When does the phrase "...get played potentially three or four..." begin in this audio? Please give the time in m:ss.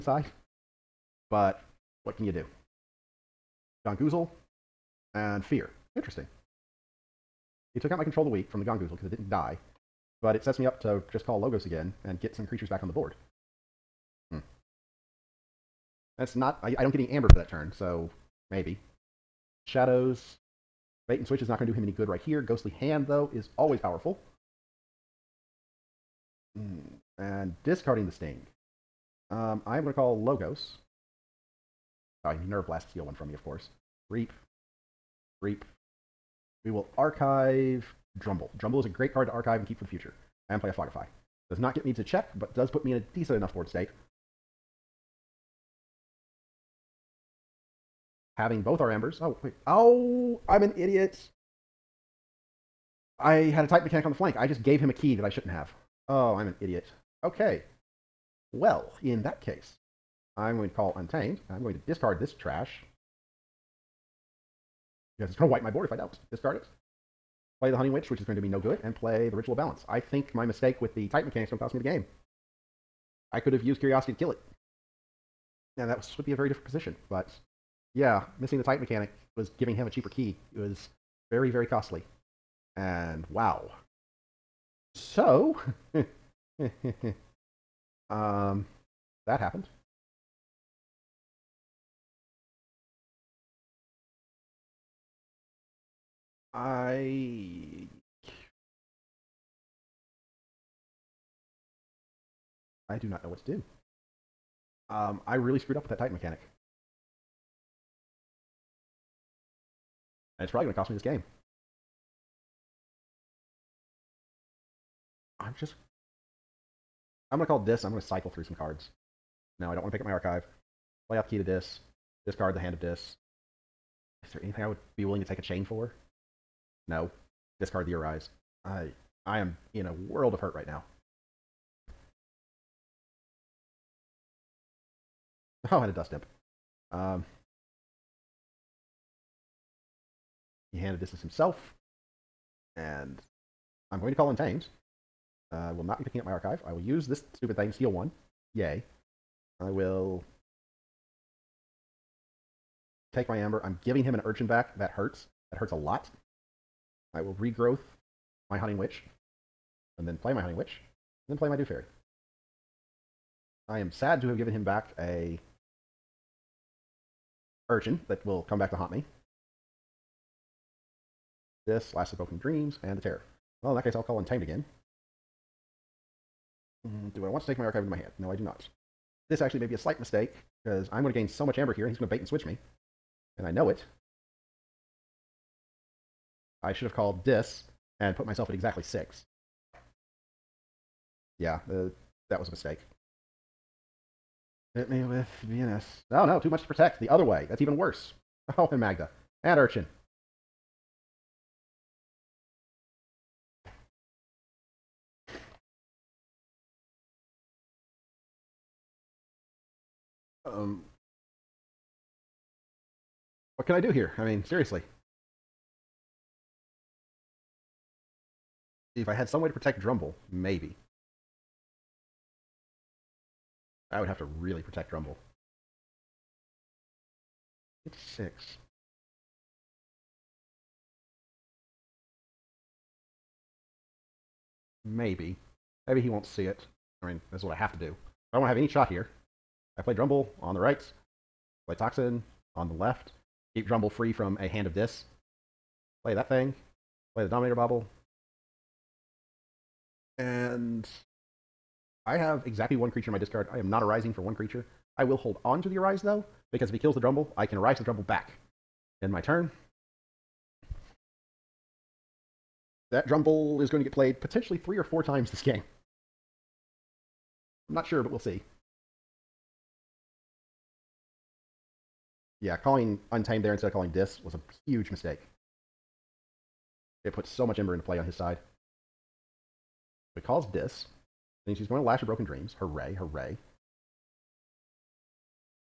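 4:23.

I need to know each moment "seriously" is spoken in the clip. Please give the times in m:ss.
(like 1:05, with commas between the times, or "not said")
3:34.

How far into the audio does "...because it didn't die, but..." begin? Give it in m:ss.
0:08.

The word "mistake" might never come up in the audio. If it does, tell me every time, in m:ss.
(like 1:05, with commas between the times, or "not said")
1:10, 2:59, 3:12, 4:34.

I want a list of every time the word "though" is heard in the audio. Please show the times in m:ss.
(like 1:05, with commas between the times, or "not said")
0:23, 4:16.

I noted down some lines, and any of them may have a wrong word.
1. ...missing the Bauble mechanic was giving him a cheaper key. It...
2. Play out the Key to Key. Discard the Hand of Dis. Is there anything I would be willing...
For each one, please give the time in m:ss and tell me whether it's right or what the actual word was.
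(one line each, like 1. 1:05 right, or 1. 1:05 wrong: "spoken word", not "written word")
1. 1:18 wrong: "Titan", not "Bauble"
2. 2:01 wrong: "Dis", not "Key".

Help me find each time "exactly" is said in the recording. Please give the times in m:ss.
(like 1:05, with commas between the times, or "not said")
3:08, 4:12.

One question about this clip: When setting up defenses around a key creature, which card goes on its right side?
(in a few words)
Tocsin.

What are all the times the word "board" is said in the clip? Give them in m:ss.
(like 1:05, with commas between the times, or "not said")
0:12, 0:43, 1:05.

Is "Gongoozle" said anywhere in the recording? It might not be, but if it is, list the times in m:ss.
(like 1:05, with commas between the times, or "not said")
0:03, 0:08.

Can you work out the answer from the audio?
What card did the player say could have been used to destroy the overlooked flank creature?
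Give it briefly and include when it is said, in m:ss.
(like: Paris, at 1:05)
Curiosity, at 1:13.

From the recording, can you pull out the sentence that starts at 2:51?
This Lash of broken dreams and the terror.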